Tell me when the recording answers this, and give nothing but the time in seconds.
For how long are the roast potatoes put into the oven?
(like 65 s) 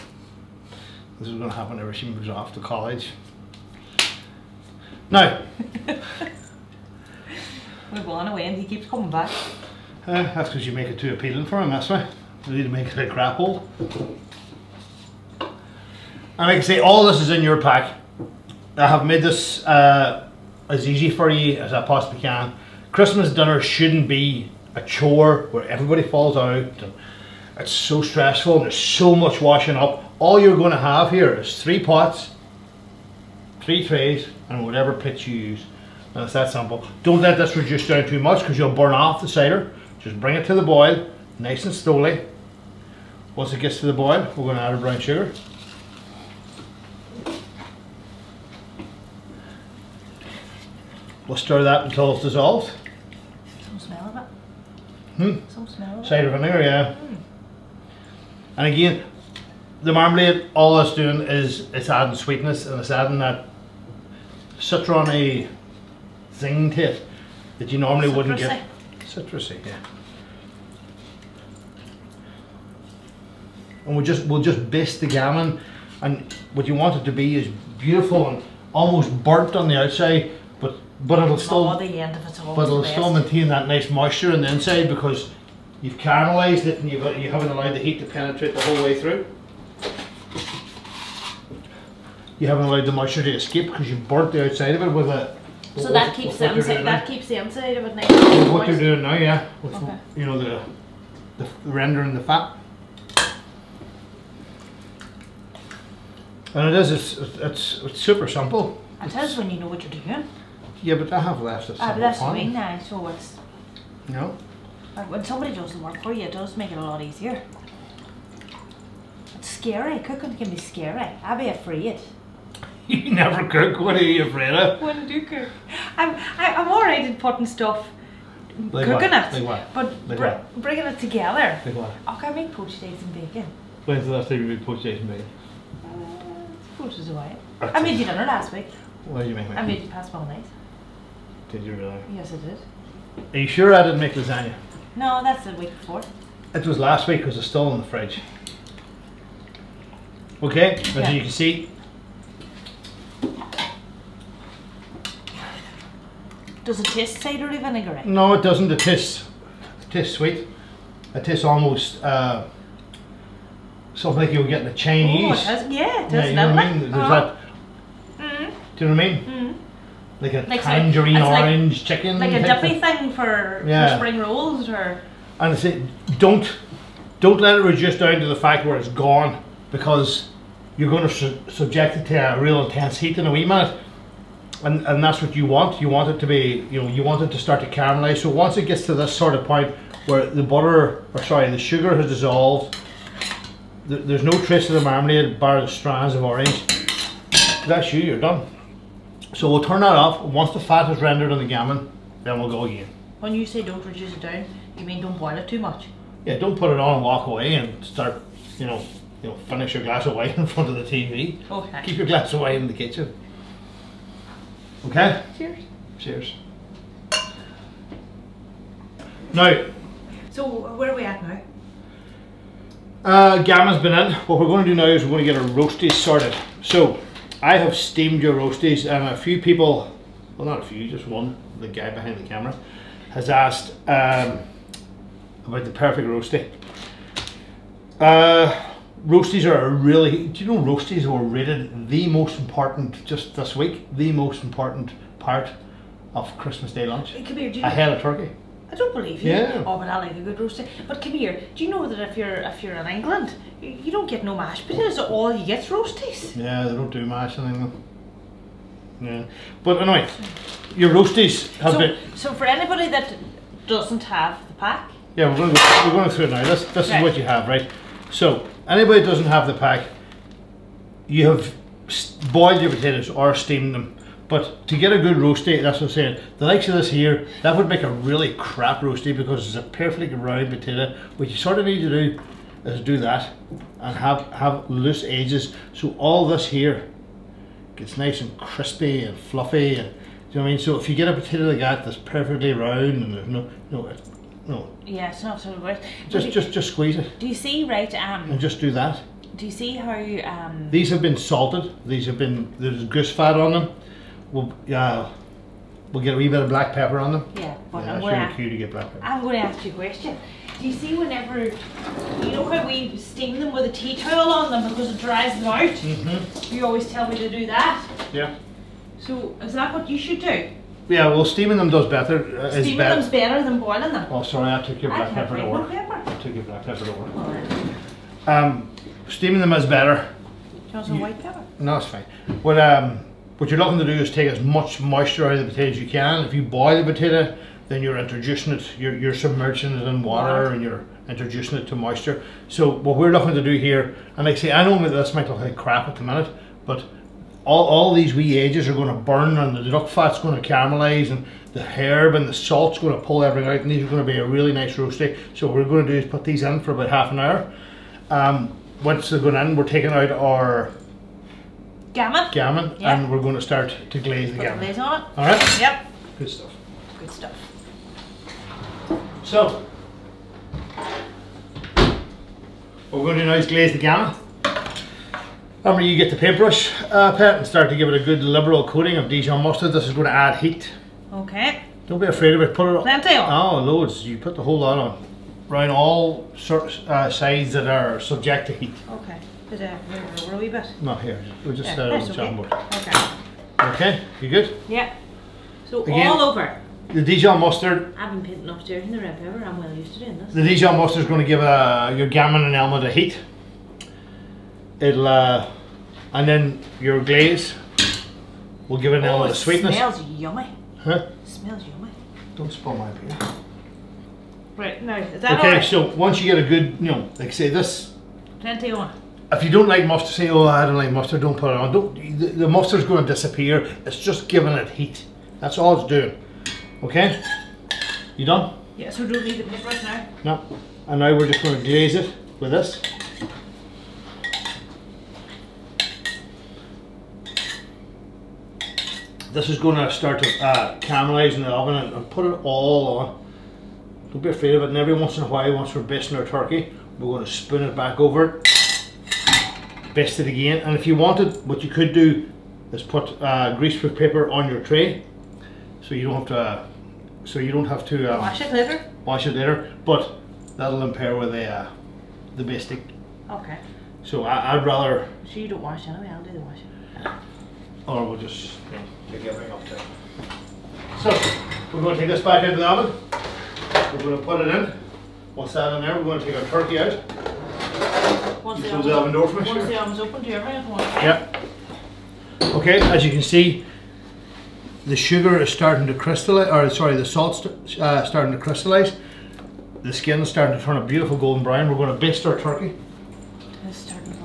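356 s.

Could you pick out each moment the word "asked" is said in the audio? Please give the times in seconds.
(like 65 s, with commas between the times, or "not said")
233 s.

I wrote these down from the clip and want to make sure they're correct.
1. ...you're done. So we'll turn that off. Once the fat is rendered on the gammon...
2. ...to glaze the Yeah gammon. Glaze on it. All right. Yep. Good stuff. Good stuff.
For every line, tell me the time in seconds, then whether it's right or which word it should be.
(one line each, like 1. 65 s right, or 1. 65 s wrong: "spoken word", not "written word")
1. 198 s right
2. 363 s wrong: "Put", not "Yeah".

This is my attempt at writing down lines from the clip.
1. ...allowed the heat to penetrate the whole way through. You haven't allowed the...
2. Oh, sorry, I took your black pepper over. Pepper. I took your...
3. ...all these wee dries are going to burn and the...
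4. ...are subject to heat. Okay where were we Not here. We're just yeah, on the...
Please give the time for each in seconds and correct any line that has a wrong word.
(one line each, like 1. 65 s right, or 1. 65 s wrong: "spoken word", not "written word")
1. 87 s right
2. 324 s right
3. 347 s wrong: "edges", not "dries"
4. 387 s right.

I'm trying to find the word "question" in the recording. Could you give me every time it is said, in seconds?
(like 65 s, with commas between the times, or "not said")
309 s.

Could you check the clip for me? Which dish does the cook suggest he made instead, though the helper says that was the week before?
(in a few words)
lasagna.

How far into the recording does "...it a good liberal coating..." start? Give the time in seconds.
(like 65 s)
377 s.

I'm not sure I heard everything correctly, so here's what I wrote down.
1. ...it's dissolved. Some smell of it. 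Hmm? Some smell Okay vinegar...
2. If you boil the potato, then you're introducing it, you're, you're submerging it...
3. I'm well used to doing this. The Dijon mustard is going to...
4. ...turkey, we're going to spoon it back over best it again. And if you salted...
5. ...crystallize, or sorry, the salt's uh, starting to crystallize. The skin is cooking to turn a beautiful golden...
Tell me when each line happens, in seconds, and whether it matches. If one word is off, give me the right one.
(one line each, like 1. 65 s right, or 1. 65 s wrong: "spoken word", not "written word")
1. 52 s wrong: "Cider", not "Okay"
2. 336 s right
3. 399 s right
4. 446 s wrong: "wanted", not "salted"
5. 485 s wrong: "starting", not "cooking".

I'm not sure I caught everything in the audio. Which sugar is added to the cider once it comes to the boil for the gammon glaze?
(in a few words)
brown sugar.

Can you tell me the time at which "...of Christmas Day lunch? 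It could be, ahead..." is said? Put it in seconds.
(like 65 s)
246 s.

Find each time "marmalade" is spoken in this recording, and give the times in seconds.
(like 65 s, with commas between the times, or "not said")
59 s, 194 s.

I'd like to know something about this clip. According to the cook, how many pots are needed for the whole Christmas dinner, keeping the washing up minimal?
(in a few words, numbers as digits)
3.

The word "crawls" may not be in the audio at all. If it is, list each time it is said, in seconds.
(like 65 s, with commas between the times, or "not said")
not said.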